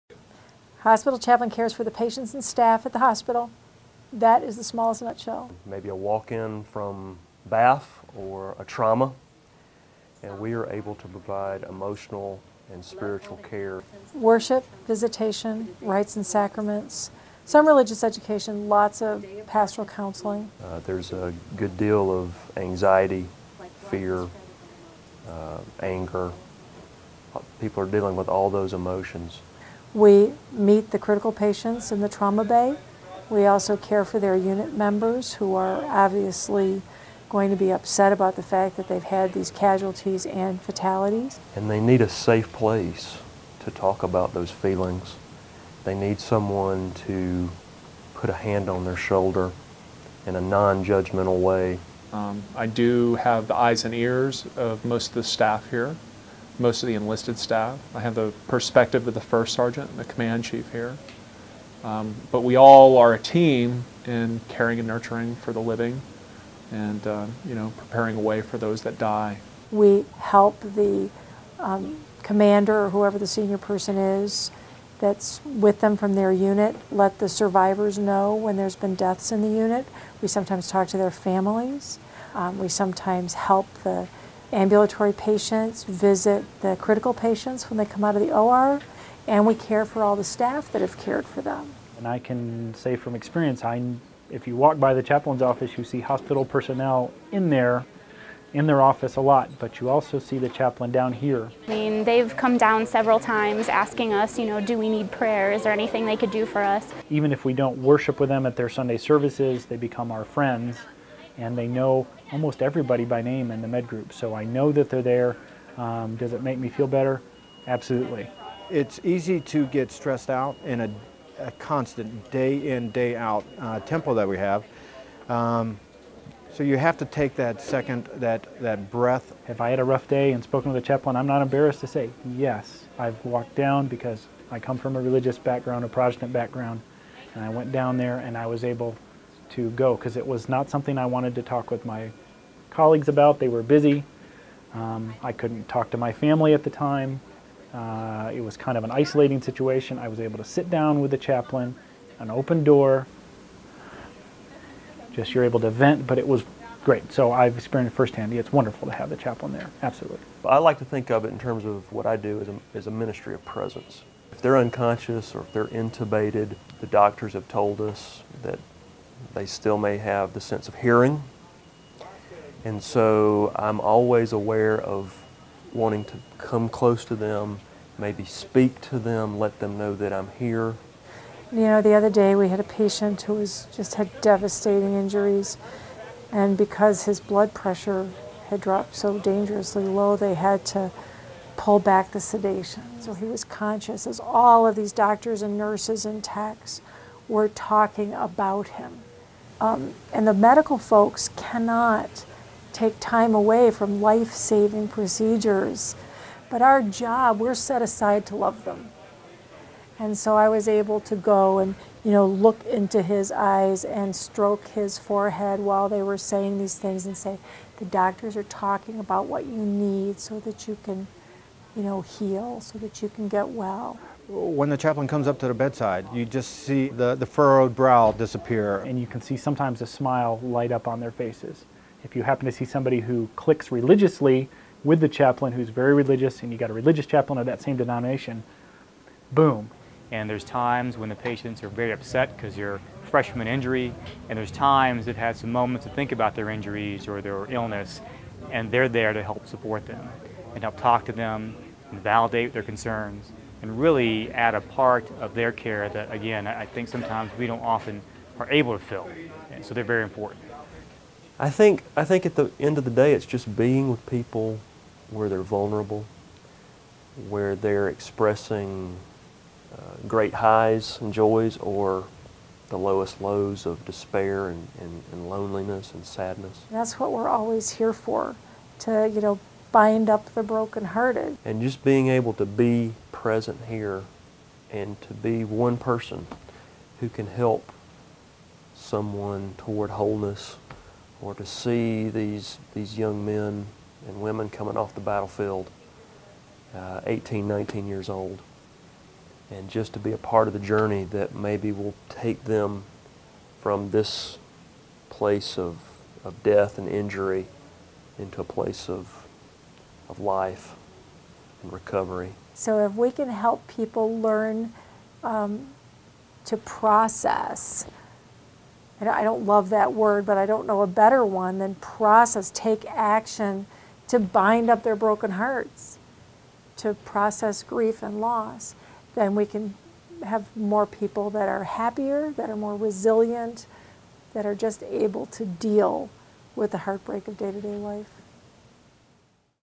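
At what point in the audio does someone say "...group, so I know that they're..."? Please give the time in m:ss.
1:53.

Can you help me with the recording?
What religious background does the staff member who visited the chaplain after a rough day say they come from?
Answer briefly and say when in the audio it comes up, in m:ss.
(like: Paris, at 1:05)
Protestant, at 2:15.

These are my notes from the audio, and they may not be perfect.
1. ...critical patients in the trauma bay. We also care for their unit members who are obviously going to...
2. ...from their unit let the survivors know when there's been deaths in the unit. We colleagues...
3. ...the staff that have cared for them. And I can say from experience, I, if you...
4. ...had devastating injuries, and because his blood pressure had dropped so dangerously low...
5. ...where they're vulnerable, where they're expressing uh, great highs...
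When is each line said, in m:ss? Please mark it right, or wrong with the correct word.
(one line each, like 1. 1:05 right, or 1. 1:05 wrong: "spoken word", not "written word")
1. 0:30 right
2. 1:15 wrong: "sometimes", not "colleagues"
3. 1:30 right
4. 3:03 right
5. 4:25 right.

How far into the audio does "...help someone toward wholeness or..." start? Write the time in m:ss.
4:47.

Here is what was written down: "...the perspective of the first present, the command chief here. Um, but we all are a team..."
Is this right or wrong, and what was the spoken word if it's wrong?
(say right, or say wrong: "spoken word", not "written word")
wrong: "sergeant", not "present".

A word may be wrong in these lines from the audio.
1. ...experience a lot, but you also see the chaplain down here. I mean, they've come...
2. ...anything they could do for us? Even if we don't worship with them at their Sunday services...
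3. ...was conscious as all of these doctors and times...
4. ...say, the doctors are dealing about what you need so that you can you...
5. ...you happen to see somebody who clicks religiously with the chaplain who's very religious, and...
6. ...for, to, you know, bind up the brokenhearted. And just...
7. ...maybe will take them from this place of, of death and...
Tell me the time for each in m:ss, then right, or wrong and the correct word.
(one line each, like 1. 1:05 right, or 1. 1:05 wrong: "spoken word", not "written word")
1. 1:38 wrong: "office", not "experience"
2. 1:45 right
3. 3:13 wrong: "nurses", not "times"
4. 3:37 wrong: "talking", not "dealing"
5. 3:52 right
6. 4:37 right
7. 5:01 right.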